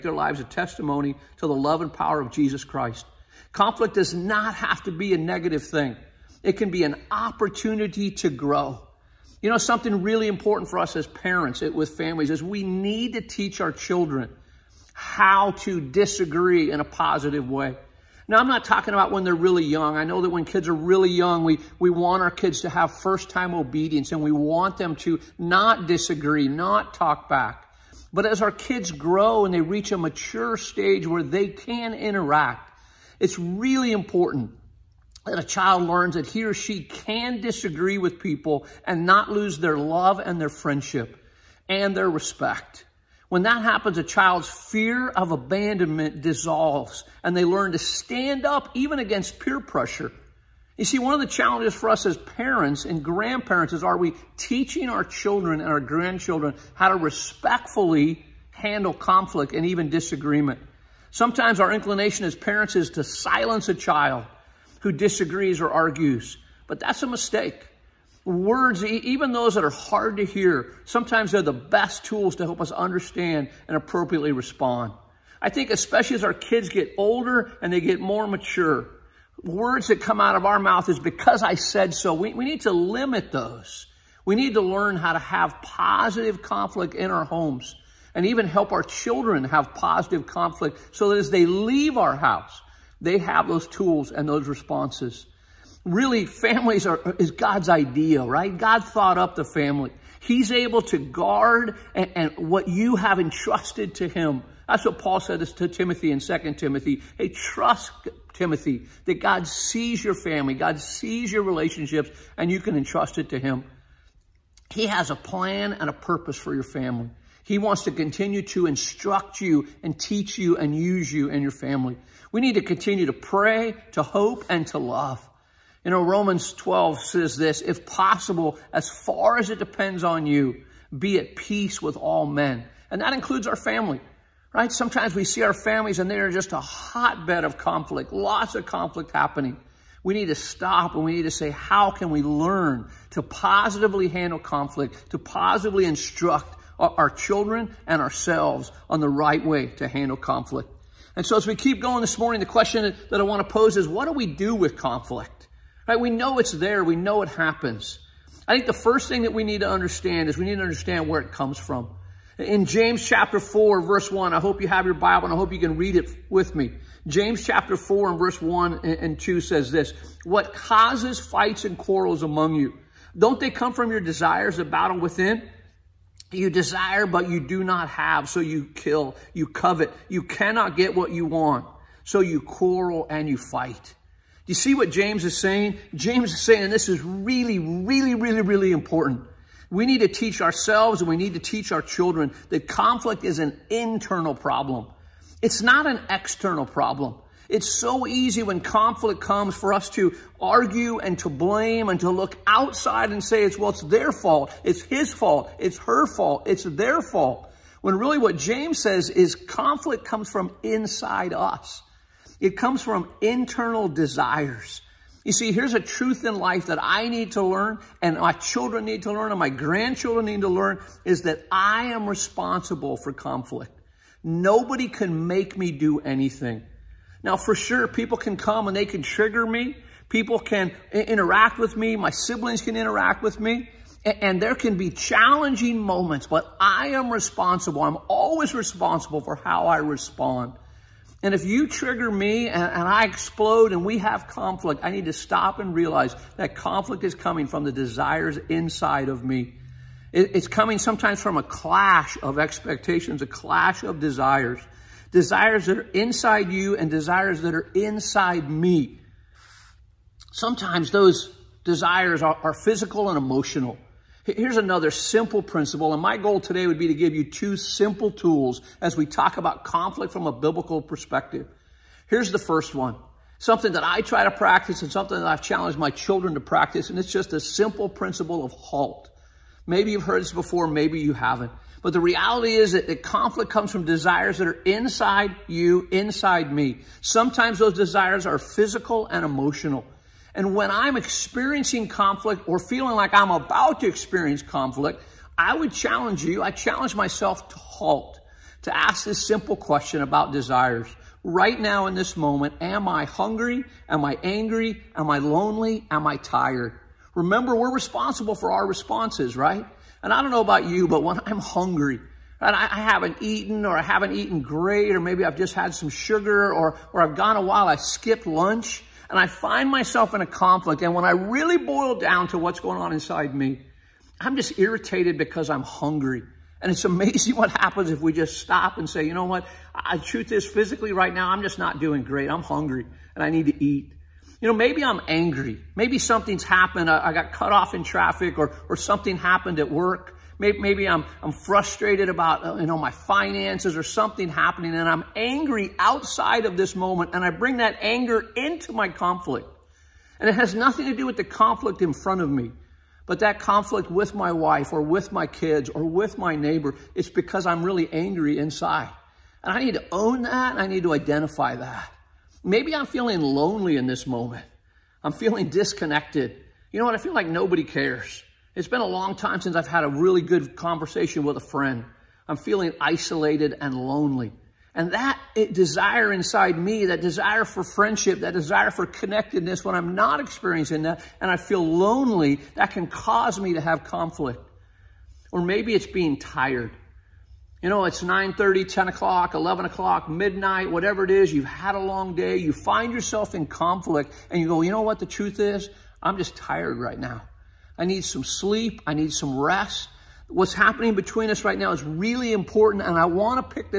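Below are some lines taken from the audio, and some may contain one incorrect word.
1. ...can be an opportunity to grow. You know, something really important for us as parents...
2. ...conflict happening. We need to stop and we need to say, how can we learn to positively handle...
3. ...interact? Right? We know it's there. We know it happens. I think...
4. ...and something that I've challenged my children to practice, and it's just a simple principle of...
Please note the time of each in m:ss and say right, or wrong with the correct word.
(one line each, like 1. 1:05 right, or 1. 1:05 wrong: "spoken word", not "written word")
1. 0:06 right
2. 2:18 right
3. 2:34 wrong: "conflict", not "interact"
4. 4:34 right.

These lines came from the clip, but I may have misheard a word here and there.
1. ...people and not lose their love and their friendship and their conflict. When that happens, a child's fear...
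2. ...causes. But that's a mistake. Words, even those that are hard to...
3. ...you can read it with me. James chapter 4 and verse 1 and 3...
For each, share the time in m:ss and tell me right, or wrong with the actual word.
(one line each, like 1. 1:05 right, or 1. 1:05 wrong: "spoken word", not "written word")
1. 0:38 wrong: "respect", not "conflict"
2. 1:05 wrong: "argues", not "causes"
3. 2:45 wrong: "2", not "3".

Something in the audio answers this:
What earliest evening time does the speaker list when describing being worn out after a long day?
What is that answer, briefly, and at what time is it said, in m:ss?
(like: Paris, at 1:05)
9:30, at 6:28.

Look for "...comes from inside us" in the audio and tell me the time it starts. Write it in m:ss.
3:30.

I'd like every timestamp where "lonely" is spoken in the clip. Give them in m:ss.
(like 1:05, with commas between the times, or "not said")
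5:05, 6:03, 6:13, 6:21.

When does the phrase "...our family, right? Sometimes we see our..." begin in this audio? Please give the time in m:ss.
2:13.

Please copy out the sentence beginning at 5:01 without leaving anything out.
Right now in this moment, am I hungry?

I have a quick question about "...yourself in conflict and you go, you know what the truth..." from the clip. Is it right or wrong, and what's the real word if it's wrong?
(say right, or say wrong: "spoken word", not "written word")
right.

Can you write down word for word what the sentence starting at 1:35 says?
Really, families are, is God's idea, right?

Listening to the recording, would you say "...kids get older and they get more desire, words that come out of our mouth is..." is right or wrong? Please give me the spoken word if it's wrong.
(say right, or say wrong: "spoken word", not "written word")
wrong: "mature", not "desire".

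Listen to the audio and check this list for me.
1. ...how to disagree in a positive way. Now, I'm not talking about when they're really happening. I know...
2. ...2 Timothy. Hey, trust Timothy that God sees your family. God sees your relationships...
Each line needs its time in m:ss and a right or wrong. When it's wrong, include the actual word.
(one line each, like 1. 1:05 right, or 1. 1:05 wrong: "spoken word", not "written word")
1. 0:14 wrong: "young", not "happening"
2. 1:46 right.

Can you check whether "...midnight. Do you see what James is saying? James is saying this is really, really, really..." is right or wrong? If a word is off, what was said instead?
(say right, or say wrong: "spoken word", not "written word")
wrong: "fight", not "midnight".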